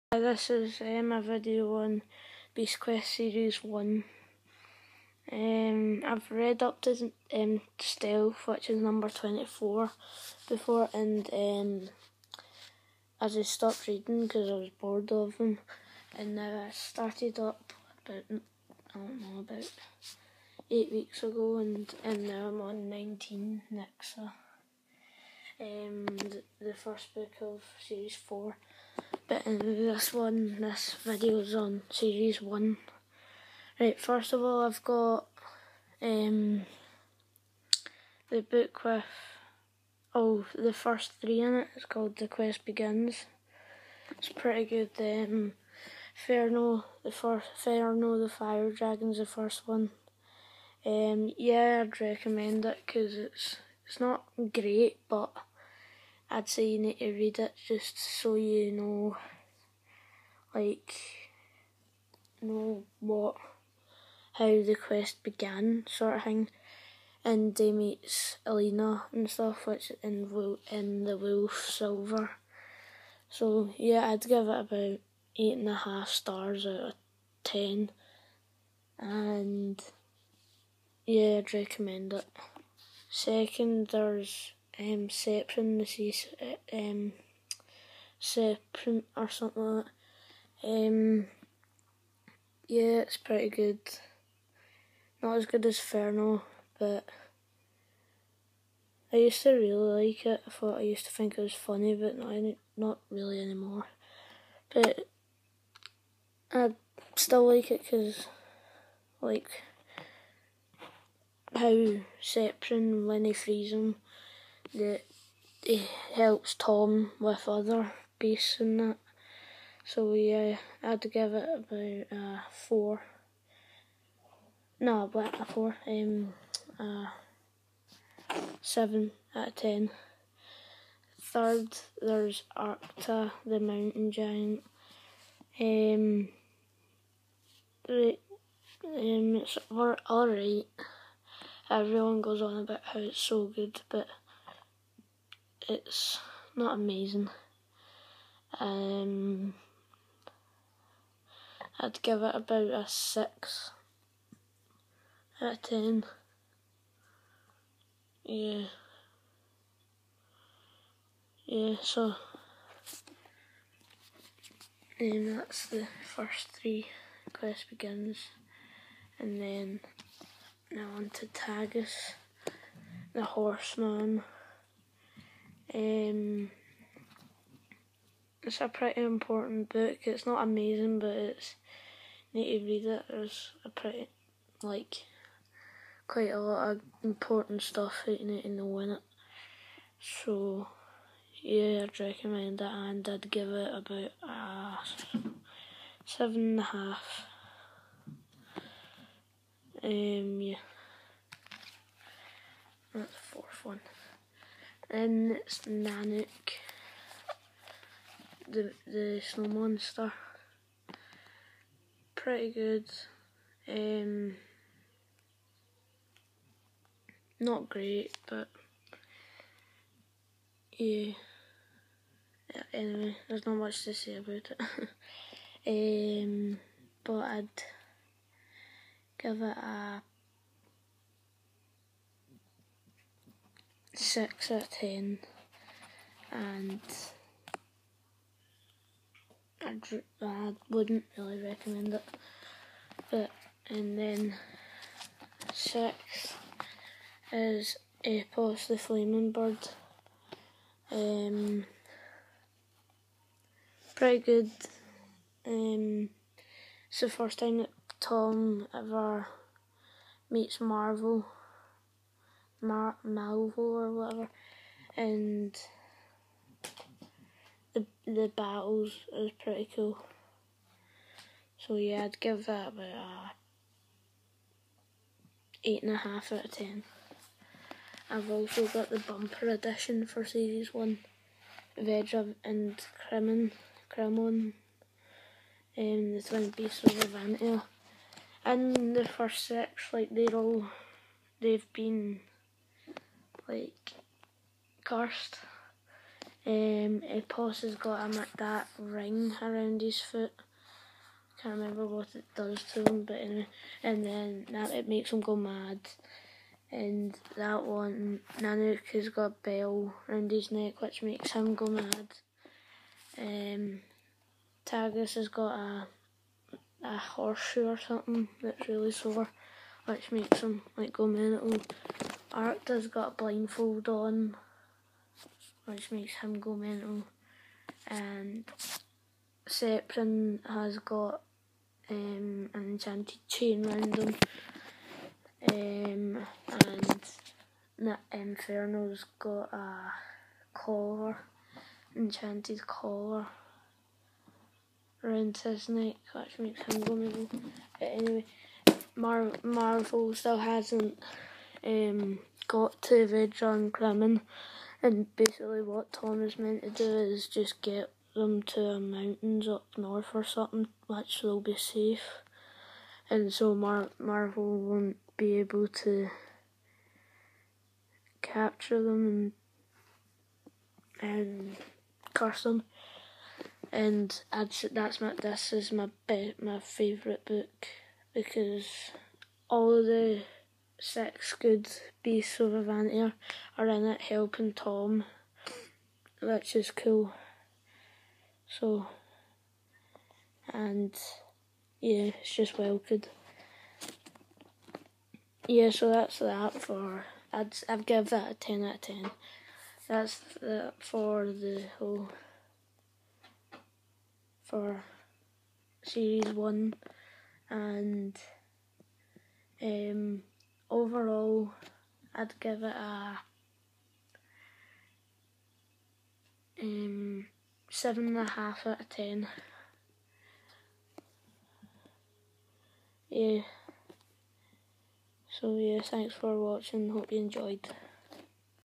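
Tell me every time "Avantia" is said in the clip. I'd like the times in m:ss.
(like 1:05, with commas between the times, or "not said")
4:46, 6:22.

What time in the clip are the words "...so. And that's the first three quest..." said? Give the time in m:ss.
2:41.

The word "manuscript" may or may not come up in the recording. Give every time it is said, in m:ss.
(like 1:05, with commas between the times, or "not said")
not said.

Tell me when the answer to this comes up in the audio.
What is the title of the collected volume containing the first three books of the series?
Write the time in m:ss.
0:42.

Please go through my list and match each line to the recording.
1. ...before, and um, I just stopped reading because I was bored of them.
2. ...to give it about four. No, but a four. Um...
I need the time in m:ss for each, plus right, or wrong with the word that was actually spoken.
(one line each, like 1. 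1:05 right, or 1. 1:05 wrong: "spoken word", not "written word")
1. 0:10 right
2. 2:01 right.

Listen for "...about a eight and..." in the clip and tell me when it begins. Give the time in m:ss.
4:32.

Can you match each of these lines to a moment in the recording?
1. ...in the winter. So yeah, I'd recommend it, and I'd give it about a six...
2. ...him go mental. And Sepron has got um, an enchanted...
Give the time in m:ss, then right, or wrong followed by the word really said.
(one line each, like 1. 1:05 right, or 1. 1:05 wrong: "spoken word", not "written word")
1. 3:08 wrong: "seven", not "six"
2. 5:26 right.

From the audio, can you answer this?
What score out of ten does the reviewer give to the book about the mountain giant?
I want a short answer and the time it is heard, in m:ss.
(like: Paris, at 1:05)
6, at 2:32.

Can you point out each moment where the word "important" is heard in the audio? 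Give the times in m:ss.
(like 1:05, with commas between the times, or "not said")
2:59, 3:07.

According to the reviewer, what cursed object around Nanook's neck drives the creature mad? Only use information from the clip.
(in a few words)
a bell.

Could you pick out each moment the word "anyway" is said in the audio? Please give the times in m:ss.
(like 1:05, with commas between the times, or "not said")
3:42, 5:03, 5:47.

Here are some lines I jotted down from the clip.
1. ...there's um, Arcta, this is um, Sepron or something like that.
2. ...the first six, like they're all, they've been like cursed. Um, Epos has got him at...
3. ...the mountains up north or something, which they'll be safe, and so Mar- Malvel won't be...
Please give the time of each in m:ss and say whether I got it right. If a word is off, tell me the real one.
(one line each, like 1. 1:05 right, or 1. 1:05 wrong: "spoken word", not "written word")
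1. 1:23 wrong: "Sepron", not "Arcta"
2. 4:48 right
3. 5:58 right.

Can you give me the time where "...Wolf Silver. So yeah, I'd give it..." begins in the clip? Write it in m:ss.
1:11.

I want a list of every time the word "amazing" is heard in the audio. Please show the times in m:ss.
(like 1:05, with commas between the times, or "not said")
2:26, 3:00.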